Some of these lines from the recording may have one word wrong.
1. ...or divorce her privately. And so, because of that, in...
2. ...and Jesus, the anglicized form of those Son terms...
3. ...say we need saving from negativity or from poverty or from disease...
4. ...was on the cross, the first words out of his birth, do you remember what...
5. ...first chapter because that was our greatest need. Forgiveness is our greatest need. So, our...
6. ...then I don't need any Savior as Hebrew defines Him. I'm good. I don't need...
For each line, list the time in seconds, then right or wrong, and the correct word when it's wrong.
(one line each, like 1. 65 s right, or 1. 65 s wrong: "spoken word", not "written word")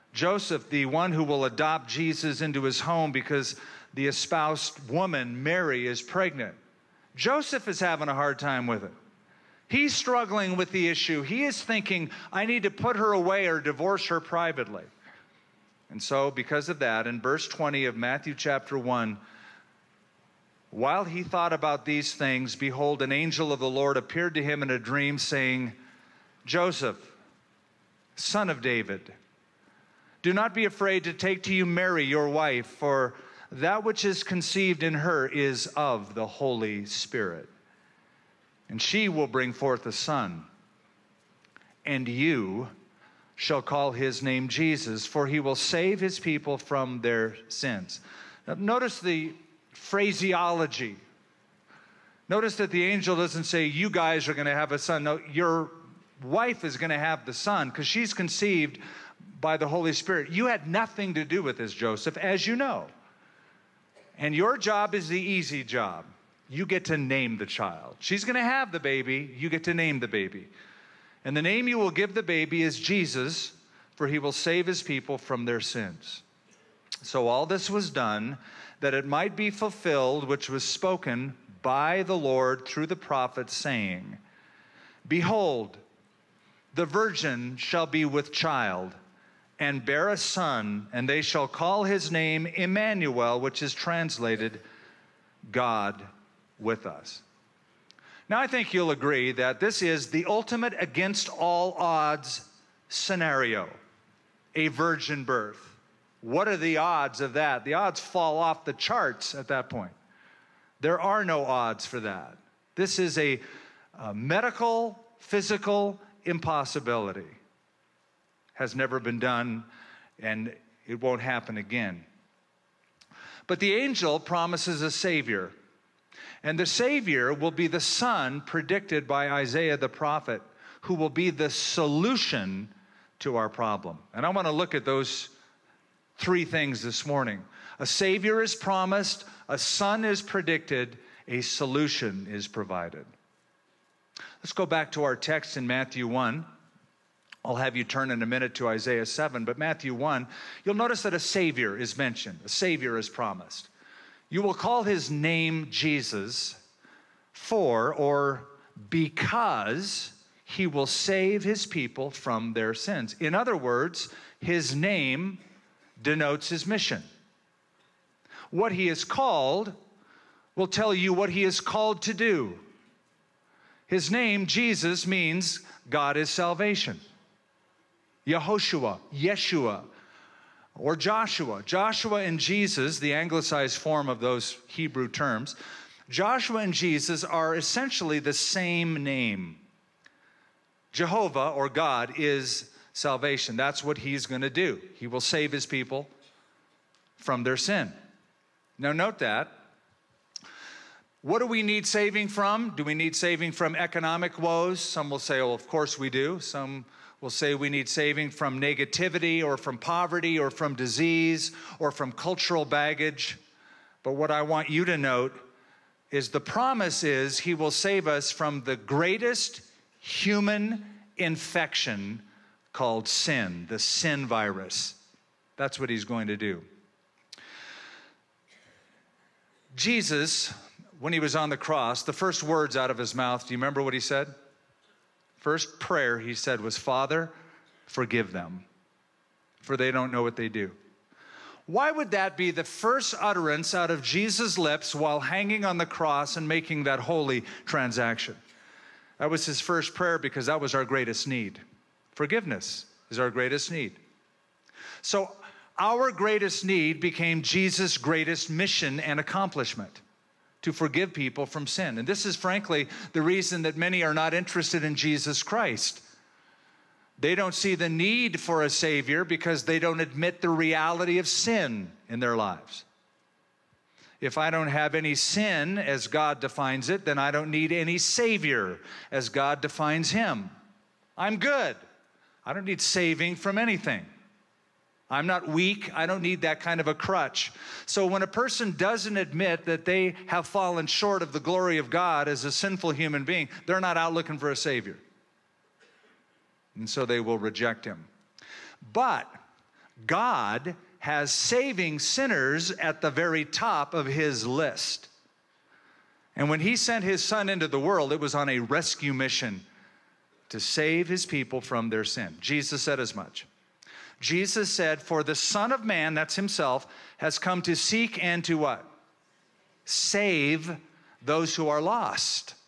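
1. 13 s right
2. 182 s wrong: "Hebrew", not "Son"
3. 207 s right
4. 231 s wrong: "mouth", not "birth"
5. 249 s wrong: "prayer", not "chapter"
6. 277 s wrong: "God", not "Hebrew".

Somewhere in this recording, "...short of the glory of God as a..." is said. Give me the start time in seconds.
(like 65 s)
290 s.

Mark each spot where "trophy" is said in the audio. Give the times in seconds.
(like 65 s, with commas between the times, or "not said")
not said.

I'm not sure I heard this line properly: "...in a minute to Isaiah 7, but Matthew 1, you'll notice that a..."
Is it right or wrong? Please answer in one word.
right.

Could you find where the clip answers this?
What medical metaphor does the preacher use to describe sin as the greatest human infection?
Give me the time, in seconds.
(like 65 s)
223 s.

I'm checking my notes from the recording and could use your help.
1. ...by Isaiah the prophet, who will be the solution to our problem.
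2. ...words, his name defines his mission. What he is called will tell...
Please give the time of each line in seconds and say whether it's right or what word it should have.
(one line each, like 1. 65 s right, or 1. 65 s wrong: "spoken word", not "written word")
1. 129 s right
2. 163 s wrong: "denotes", not "defines".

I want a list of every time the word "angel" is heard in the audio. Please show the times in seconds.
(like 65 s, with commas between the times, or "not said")
23 s, 52 s, 123 s.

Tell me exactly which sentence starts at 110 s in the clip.
There are no odds for that.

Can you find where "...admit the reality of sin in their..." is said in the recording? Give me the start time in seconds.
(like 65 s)
269 s.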